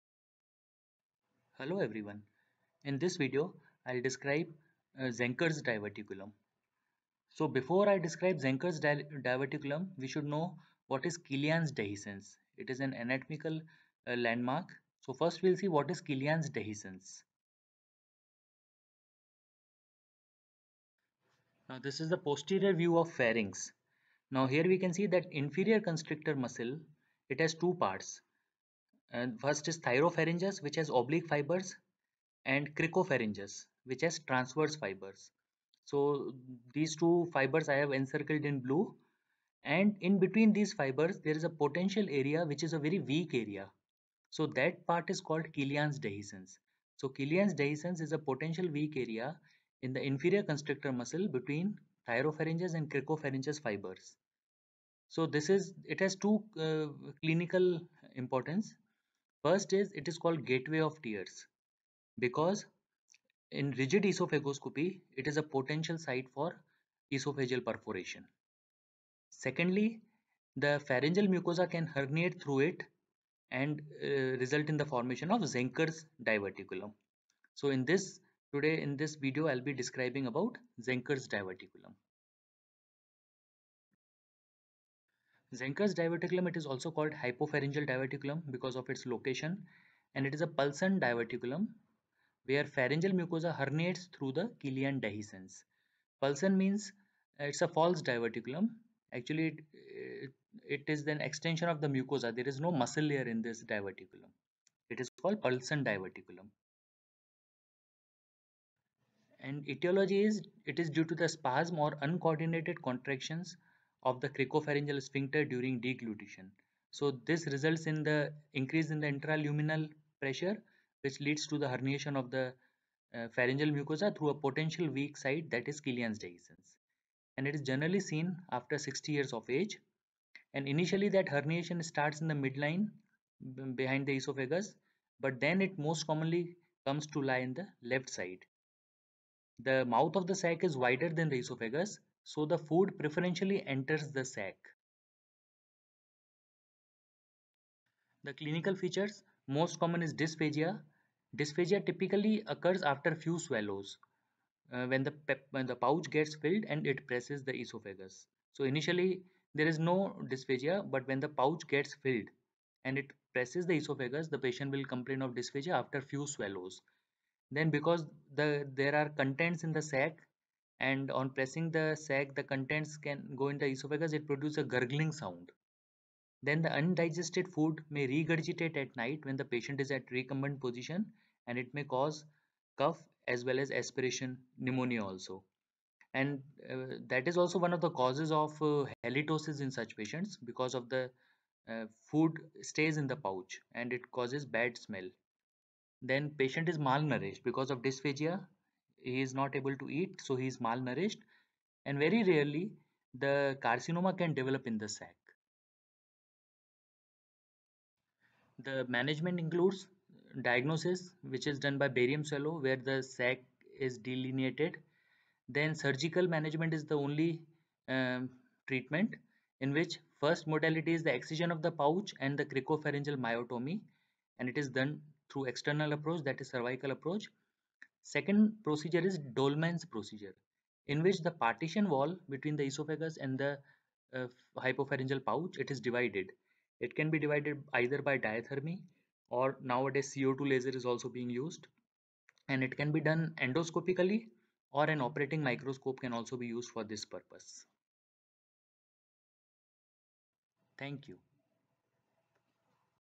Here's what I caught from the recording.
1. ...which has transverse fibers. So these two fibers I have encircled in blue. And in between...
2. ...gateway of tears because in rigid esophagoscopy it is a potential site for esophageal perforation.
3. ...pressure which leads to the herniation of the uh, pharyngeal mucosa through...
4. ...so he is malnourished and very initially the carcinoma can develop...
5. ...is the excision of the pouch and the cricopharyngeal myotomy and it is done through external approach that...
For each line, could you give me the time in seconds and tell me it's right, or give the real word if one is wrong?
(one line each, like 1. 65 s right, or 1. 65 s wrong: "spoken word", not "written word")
1. 33 s right
2. 60 s right
3. 120 s right
4. 200 s wrong: "rarely", not "initially"
5. 220 s right.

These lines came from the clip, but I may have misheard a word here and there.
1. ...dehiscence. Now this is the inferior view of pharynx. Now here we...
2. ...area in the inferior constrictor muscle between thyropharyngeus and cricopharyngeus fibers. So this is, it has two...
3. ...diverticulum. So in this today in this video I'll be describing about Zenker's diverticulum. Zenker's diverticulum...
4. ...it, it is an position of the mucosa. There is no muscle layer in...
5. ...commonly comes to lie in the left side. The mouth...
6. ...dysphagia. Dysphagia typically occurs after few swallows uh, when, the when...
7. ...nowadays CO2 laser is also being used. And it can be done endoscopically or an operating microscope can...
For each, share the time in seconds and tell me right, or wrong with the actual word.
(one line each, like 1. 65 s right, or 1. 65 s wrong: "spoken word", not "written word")
1. 16 s wrong: "posterior", not "inferior"
2. 48 s right
3. 76 s right
4. 99 s wrong: "extension", not "position"
5. 136 s right
6. 150 s right
7. 239 s right.